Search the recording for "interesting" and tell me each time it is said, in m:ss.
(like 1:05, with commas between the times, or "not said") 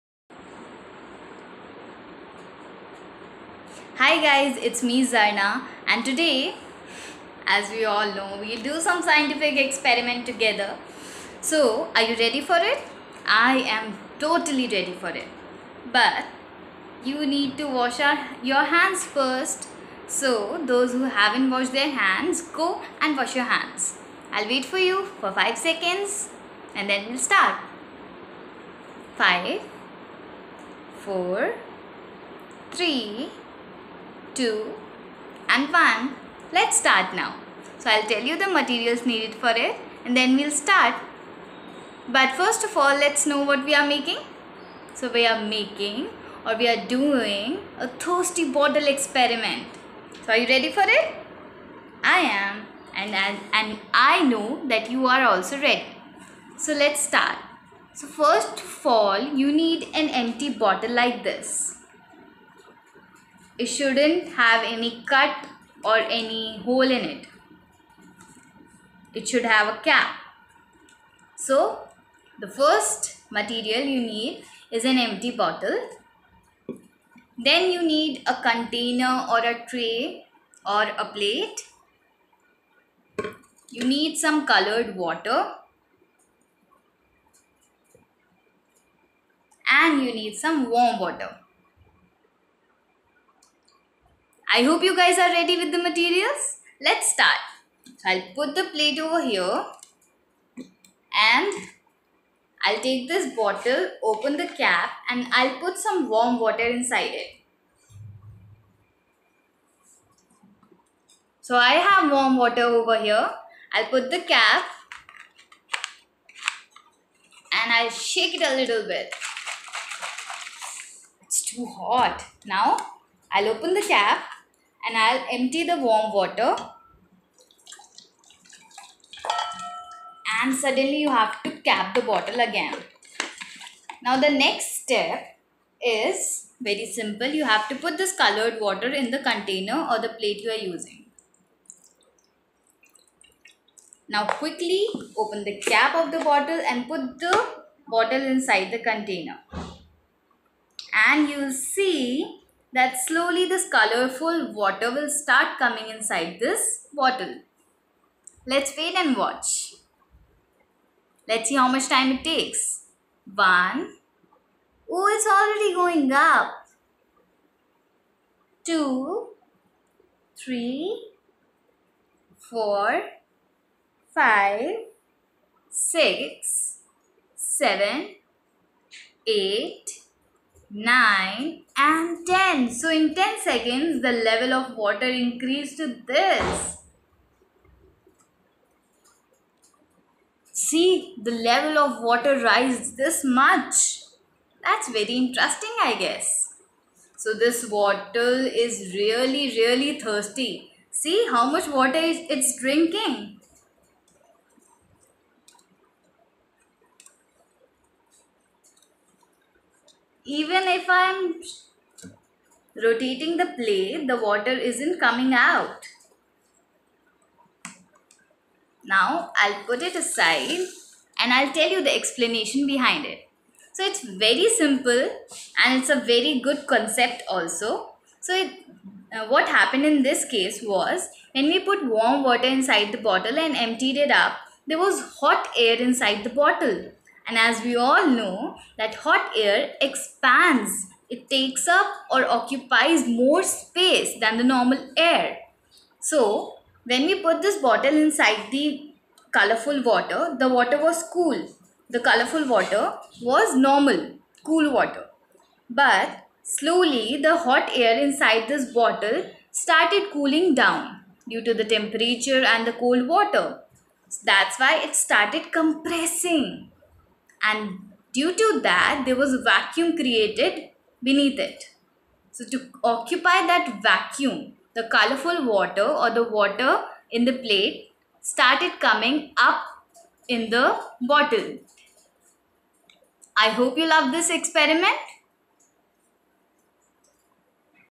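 3:15.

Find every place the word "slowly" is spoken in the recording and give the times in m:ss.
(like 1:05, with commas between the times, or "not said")
2:33, 4:16.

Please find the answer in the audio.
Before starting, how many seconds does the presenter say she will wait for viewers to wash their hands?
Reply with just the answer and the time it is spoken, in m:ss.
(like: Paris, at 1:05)
5, at 0:25.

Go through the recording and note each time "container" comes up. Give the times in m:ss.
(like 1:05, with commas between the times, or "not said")
1:18, 2:19, 2:28.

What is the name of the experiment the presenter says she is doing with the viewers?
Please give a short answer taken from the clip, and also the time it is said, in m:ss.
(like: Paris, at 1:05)
Thirsty bottle experiment, at 0:47.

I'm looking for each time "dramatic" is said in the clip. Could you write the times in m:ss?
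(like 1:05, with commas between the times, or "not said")
not said.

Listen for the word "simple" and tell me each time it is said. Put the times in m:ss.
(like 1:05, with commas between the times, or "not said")
2:16, 3:44.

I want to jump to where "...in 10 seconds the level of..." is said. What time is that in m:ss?
3:02.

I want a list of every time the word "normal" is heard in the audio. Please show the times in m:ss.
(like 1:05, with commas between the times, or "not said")
4:04, 4:13.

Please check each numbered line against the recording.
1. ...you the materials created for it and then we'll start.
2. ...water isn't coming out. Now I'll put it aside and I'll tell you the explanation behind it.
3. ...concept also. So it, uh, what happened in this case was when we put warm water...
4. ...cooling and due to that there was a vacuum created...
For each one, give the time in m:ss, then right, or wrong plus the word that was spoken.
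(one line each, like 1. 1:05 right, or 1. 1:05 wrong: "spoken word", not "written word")
1. 0:38 wrong: "needed", not "created"
2. 3:34 right
3. 3:46 right
4. 4:25 wrong: "compressing", not "cooling".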